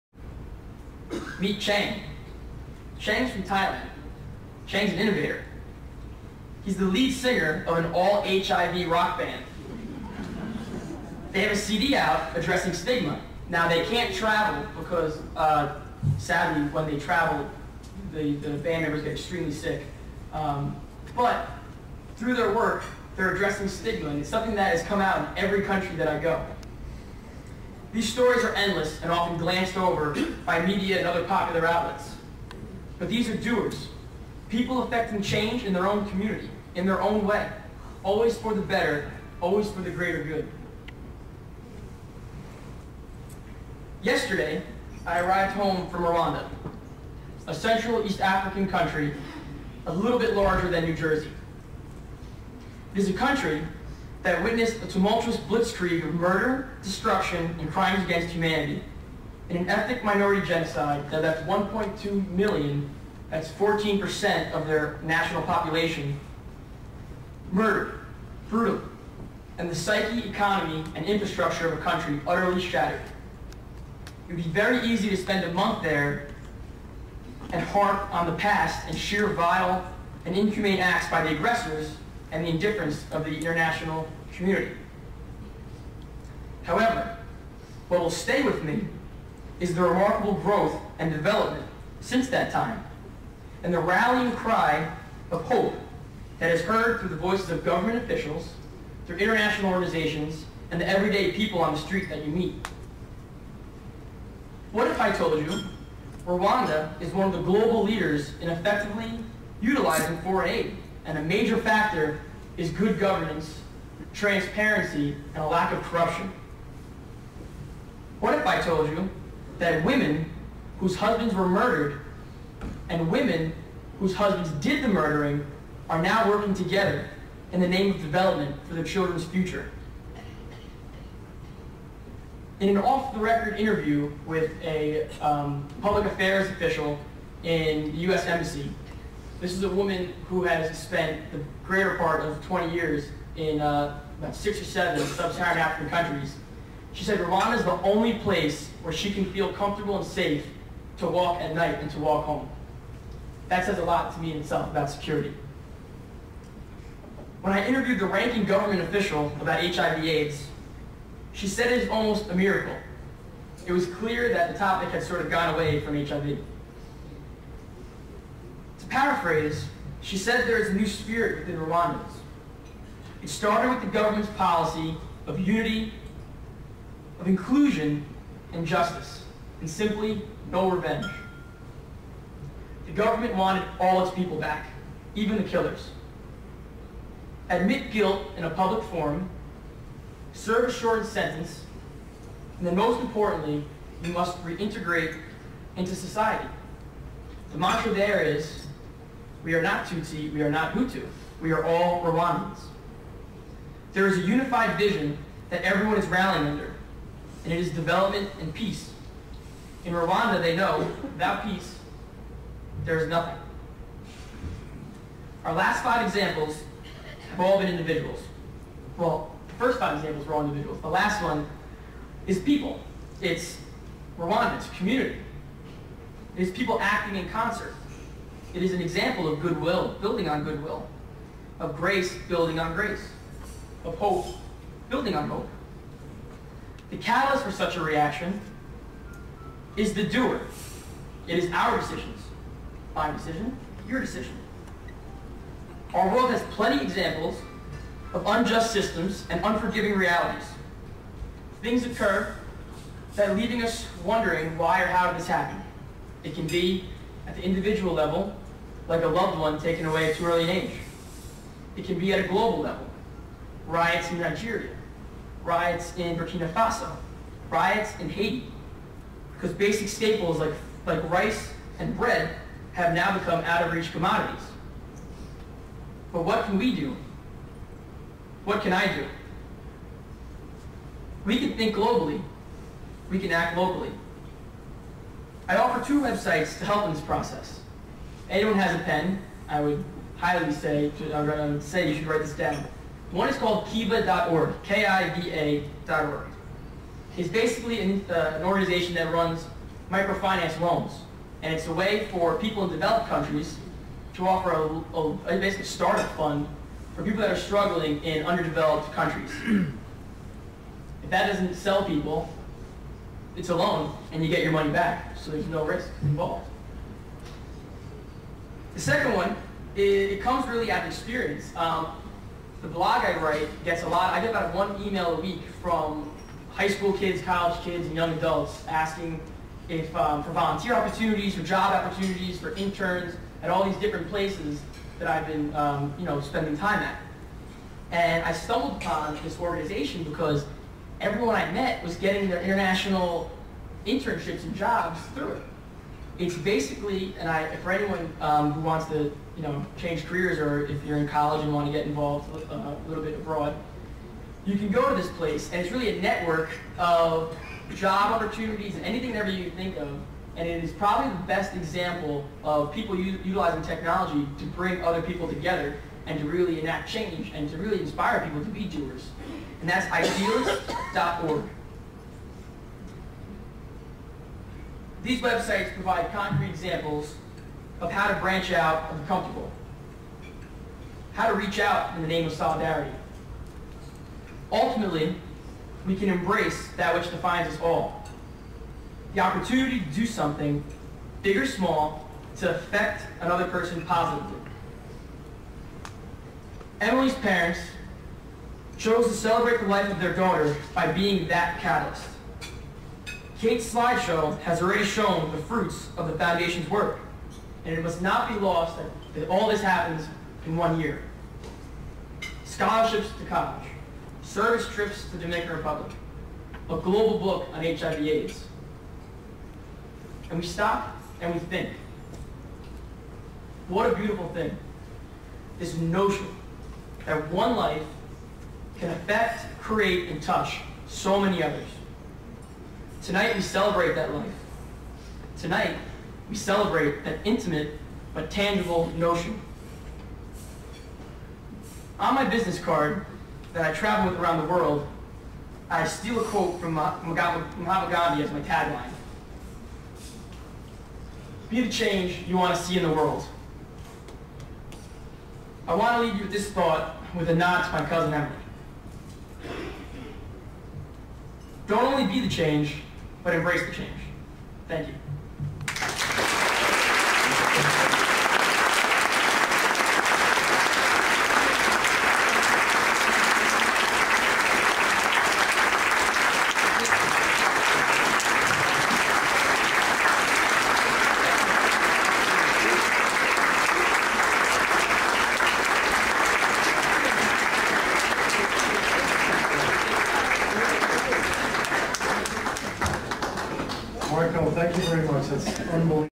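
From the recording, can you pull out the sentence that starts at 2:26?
She said Rwanda is the only place where she can feel comfortable and safe to walk at night and to walk home.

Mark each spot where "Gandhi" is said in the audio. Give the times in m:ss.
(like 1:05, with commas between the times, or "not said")
7:27.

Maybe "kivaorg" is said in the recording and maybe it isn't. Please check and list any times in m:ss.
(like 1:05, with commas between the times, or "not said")
4:53.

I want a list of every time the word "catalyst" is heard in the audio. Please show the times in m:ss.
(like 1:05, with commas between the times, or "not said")
3:56, 6:41.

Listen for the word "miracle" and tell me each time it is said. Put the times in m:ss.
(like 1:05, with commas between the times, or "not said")
2:42.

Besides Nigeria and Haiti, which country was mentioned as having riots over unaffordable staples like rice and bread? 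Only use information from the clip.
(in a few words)
Burkina Faso.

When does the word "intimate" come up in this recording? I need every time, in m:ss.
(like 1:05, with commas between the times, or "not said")
7:17.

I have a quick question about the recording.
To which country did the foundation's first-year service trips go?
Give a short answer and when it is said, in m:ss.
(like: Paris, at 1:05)
Dominican Republic, at 6:55.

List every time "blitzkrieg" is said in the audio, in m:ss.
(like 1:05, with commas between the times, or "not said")
0:55.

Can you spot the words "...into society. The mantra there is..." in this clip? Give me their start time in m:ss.
3:15.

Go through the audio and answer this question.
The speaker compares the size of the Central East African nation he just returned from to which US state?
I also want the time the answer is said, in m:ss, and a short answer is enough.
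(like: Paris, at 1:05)
New Jersey, at 0:50.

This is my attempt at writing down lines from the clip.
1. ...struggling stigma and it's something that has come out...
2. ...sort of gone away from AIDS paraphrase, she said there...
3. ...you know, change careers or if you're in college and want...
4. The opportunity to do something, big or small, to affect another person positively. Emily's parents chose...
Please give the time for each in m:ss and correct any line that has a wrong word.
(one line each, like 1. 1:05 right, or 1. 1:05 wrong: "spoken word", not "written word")
1. 0:23 wrong: "addressing", not "struggling"
2. 2:45 wrong: "HIV", not "AIDS"
3. 5:49 right
4. 6:29 right.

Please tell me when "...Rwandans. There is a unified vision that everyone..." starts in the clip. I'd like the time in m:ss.
3:22.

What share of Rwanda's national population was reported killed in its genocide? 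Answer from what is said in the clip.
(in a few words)
14%.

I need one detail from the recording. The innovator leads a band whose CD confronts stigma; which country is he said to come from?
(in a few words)
Thailand.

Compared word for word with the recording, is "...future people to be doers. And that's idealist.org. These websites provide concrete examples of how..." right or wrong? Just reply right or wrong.
wrong.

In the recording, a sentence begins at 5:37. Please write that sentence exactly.
And I stumbled upon this organization because everyone I met was getting their international internships and jobs through it.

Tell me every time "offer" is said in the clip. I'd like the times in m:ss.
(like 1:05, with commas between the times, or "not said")
4:45, 5:04.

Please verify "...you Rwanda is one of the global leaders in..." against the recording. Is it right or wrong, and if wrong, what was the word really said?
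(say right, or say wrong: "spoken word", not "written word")
right.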